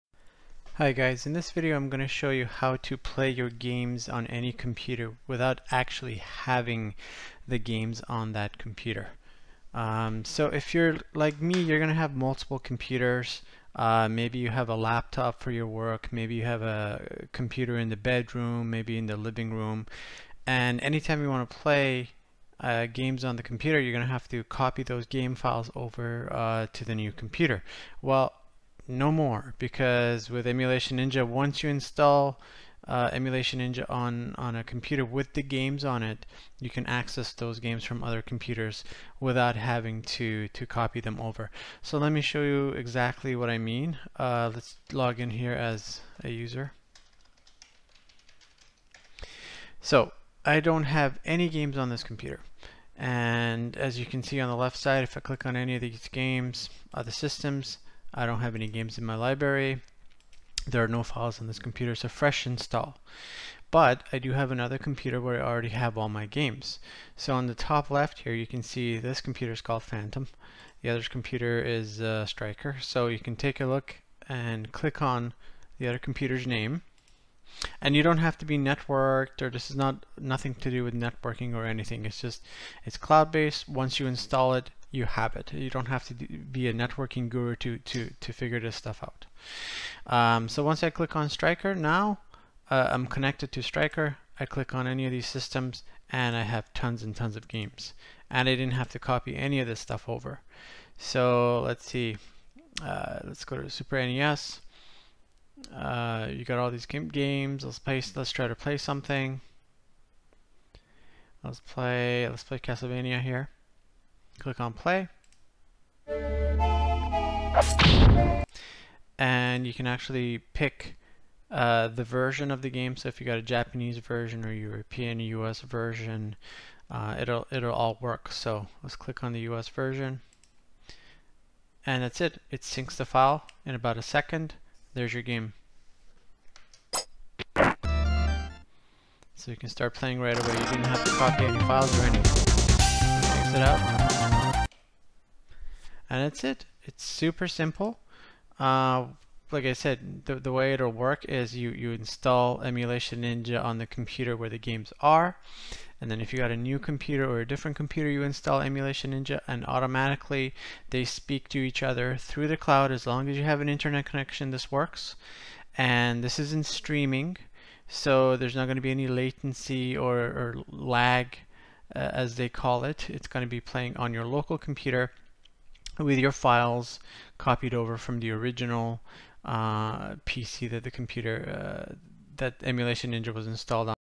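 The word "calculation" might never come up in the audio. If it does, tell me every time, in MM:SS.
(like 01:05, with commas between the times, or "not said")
not said.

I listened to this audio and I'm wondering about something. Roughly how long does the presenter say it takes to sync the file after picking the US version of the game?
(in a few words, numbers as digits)
about a second.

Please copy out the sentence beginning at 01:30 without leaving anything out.
Um, so once I click on Striker, now uh, I'm connected to Striker.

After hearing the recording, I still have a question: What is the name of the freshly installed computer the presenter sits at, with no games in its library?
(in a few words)
Phantom.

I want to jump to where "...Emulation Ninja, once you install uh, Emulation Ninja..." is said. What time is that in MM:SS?
00:30.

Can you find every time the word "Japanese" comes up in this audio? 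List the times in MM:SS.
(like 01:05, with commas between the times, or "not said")
02:03.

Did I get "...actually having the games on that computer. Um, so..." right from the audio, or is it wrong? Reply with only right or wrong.
right.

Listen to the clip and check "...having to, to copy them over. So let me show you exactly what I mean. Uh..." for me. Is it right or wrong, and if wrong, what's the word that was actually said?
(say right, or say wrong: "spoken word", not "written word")
right.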